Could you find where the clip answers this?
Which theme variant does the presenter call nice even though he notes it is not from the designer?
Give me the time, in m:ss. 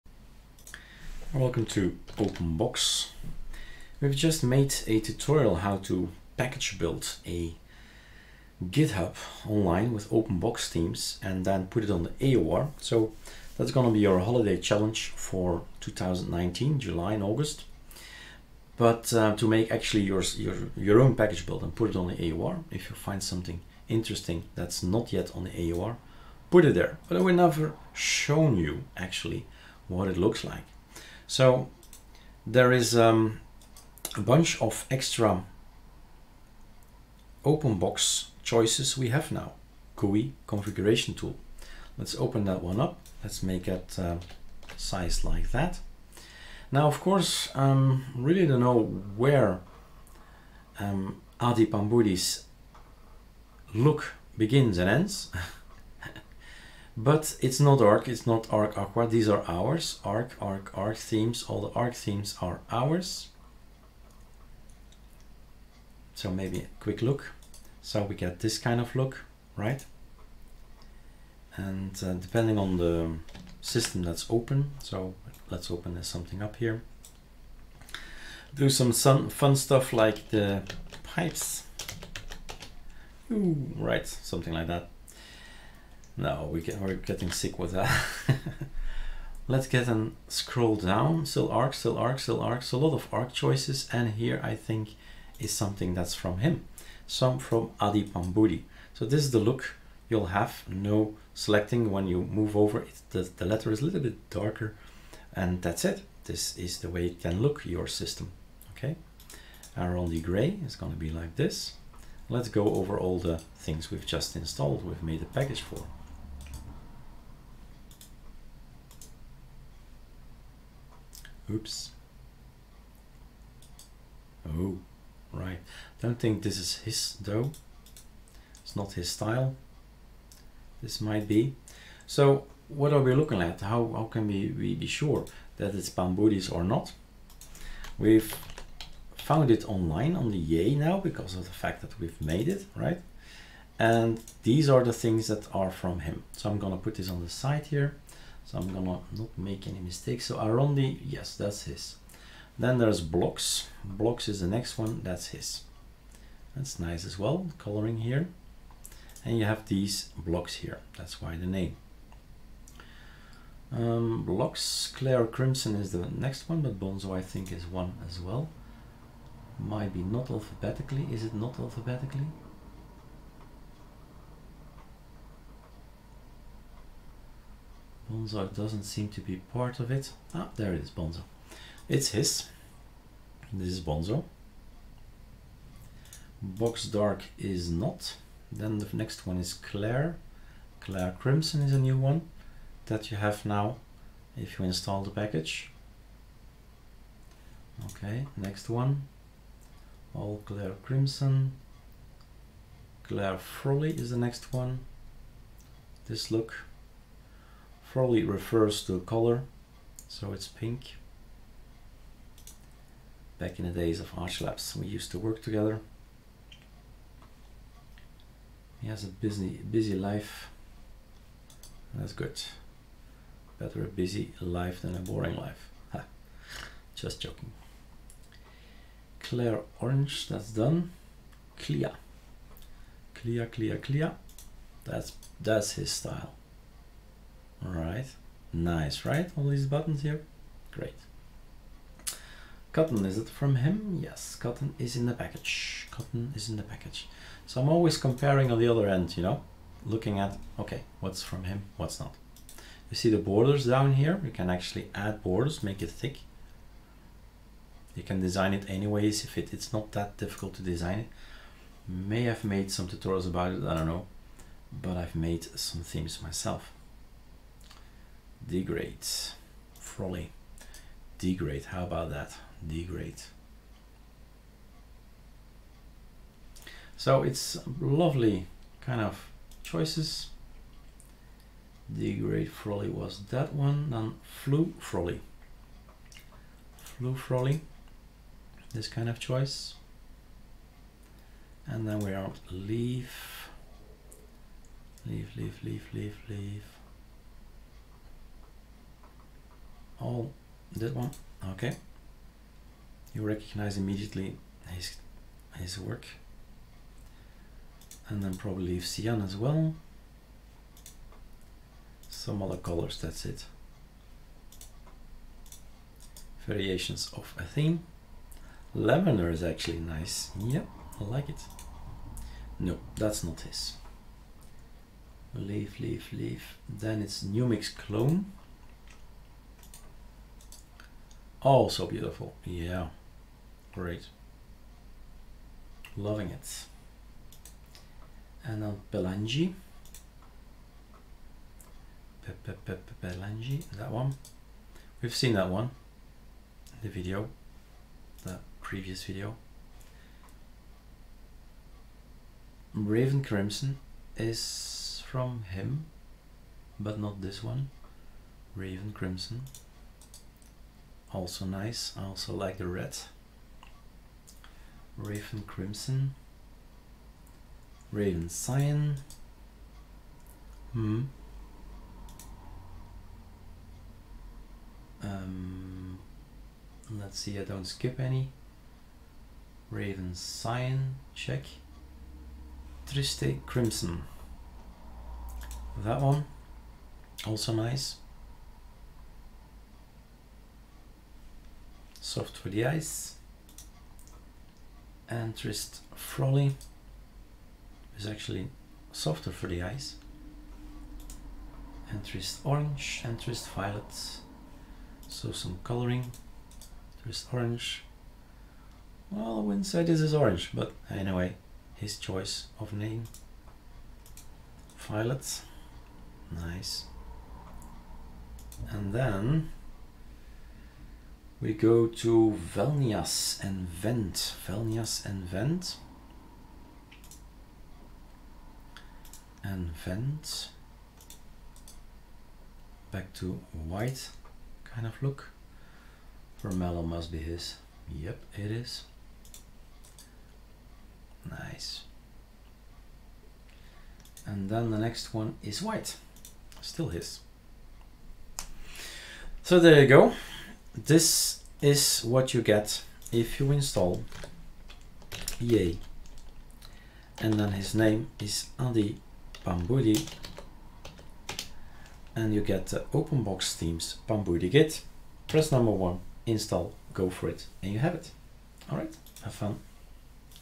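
5:18.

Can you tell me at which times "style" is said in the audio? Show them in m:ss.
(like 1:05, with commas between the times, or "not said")
2:09, 3:55.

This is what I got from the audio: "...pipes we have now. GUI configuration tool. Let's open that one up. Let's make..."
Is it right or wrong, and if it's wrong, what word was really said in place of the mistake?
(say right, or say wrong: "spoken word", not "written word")
wrong: "choices", not "pipes".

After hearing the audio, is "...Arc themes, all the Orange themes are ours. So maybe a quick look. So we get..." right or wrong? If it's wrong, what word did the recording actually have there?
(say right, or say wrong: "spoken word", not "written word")
wrong: "Arc", not "Orange".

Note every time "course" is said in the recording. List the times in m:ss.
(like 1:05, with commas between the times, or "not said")
0:46.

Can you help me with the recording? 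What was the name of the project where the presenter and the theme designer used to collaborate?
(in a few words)
Archlabs.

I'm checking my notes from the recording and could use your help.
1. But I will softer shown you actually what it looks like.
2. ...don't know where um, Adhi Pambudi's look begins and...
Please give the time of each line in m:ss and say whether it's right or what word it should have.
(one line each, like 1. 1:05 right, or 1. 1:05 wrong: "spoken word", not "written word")
1. 0:27 wrong: "never", not "softer"
2. 0:48 right.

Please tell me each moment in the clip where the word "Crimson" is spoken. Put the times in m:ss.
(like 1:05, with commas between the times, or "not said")
2:45, 3:11, 3:20, 5:53, 5:58, 6:05, 6:23.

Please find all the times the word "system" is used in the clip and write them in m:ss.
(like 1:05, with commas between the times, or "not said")
1:13, 1:47.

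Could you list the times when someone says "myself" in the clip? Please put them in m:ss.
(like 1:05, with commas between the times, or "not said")
4:26.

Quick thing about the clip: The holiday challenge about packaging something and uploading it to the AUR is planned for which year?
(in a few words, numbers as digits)
2019.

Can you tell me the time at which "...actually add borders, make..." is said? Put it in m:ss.
4:14.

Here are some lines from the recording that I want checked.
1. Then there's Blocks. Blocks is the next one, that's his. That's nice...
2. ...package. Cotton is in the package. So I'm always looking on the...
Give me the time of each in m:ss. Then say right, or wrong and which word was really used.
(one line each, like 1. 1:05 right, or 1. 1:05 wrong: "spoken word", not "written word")
1. 2:32 right
2. 4:05 wrong: "comparing", not "looking".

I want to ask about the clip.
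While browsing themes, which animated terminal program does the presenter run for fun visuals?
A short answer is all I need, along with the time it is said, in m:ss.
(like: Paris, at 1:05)
pipes, at 1:21.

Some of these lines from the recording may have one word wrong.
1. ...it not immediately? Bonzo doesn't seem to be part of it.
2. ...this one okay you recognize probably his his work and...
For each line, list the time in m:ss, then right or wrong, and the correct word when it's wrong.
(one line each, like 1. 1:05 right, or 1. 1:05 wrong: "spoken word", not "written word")
1. 2:51 wrong: "alphabetically", not "immediately"
2. 5:00 wrong: "immediately", not "probably".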